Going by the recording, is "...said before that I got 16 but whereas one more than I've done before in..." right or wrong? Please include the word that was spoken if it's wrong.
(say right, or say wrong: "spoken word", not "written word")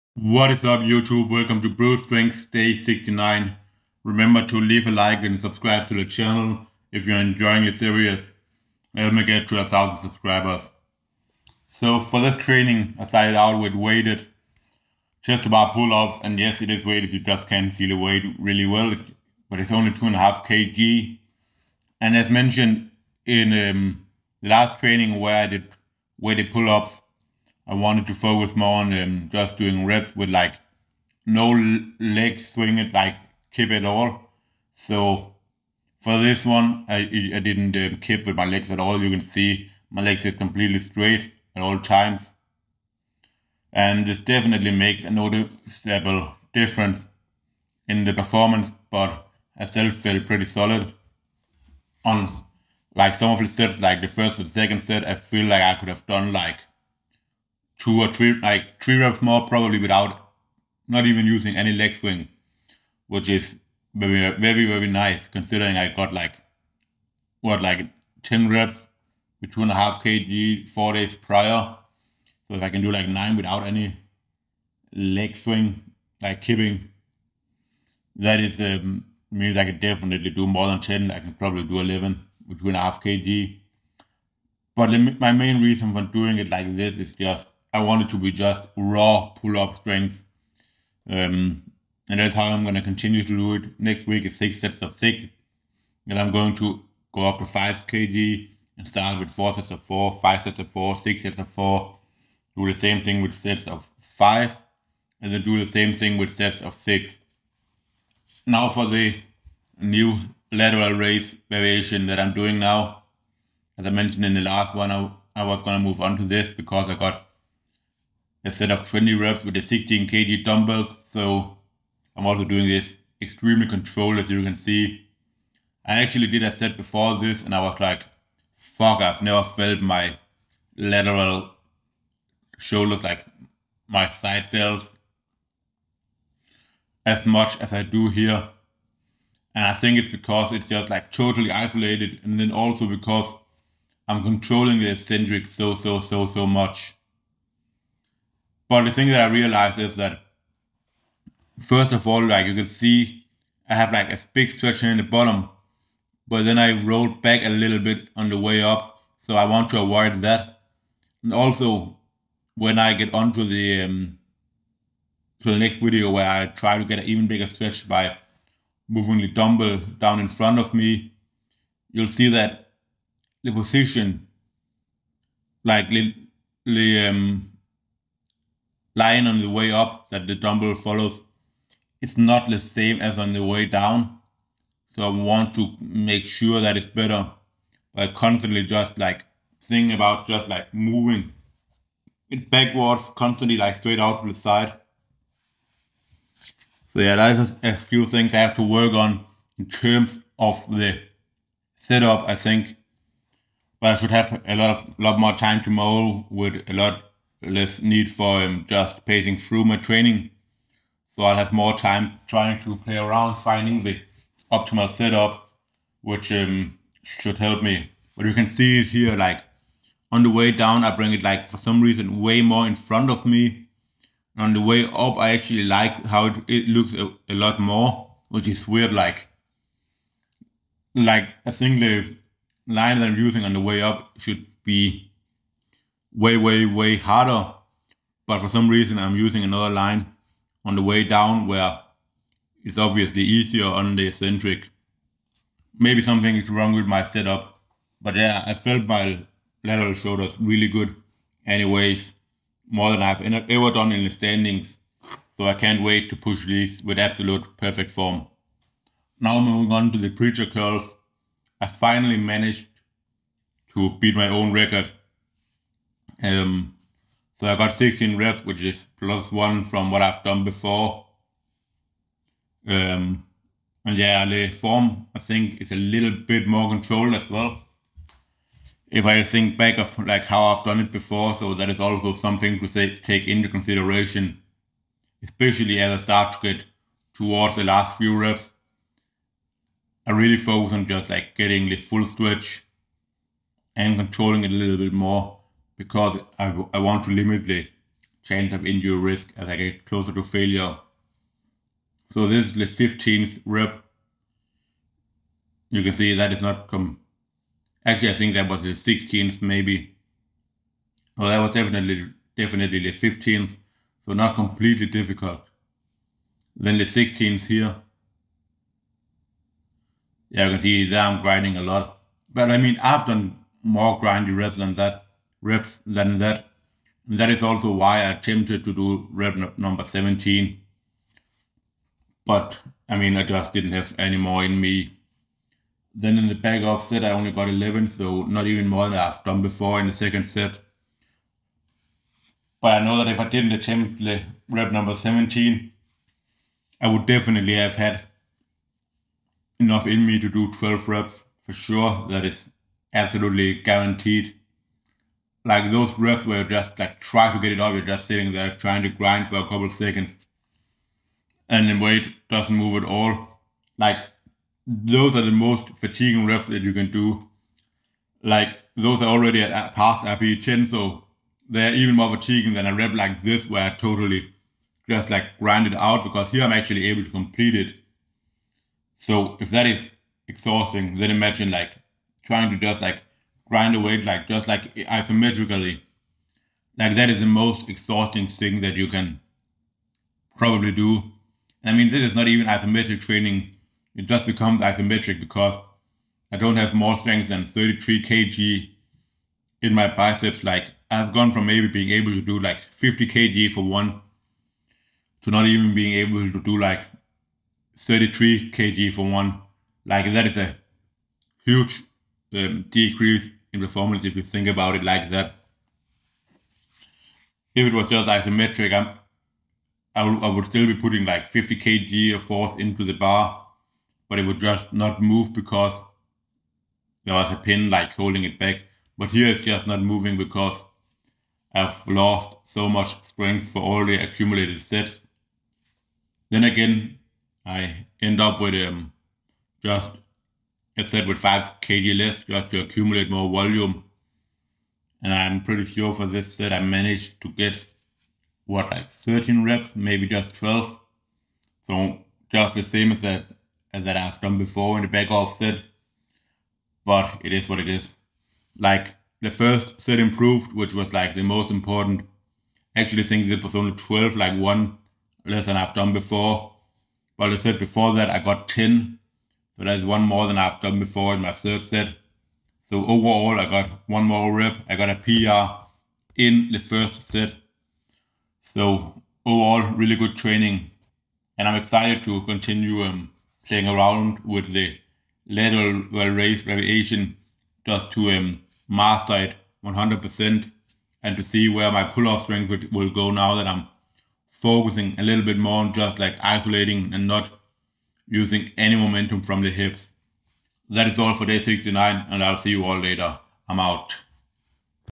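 wrong: "10", not "16".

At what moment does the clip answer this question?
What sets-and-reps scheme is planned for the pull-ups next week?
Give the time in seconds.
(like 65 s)
94 s.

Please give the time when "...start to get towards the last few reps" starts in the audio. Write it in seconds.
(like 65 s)
286 s.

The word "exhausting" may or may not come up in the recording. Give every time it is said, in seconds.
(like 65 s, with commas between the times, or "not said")
380 s, 387 s.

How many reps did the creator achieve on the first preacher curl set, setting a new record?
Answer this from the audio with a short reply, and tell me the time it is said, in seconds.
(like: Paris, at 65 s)
16, at 267 s.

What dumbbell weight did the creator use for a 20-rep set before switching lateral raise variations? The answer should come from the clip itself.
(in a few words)
16 kg.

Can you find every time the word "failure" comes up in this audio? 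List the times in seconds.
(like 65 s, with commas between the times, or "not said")
300 s.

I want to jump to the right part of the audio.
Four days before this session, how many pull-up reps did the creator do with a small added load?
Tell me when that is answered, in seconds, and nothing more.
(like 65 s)
68 s.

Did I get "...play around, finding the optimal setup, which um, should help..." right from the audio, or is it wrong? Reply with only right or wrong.
right.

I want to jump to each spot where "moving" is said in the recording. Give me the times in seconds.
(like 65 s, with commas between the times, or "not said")
168 s, 190 s, 259 s, 429 s.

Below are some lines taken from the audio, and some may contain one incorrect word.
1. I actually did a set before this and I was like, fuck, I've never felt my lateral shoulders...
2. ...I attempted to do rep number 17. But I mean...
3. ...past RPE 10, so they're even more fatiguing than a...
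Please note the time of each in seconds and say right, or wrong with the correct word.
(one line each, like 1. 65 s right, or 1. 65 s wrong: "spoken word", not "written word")
1. 125 s right
2. 328 s right
3. 369 s right.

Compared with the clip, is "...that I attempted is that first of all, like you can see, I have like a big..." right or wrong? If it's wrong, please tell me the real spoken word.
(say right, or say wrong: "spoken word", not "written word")
wrong: "realized", not "attempted".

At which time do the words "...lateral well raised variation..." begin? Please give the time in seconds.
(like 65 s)
485 s.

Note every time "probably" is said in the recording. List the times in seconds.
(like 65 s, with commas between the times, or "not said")
59 s, 81 s, 390 s.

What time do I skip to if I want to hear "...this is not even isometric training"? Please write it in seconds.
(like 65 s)
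391 s.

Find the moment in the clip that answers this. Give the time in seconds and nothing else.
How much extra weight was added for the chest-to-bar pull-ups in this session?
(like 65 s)
19 s.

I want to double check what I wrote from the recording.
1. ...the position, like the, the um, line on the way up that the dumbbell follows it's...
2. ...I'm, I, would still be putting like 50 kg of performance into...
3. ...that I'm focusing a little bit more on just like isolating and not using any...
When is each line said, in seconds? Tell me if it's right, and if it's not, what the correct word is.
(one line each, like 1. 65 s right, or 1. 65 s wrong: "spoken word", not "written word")
1. 173 s right
2. 419 s wrong: "force", not "performance"
3. 493 s right.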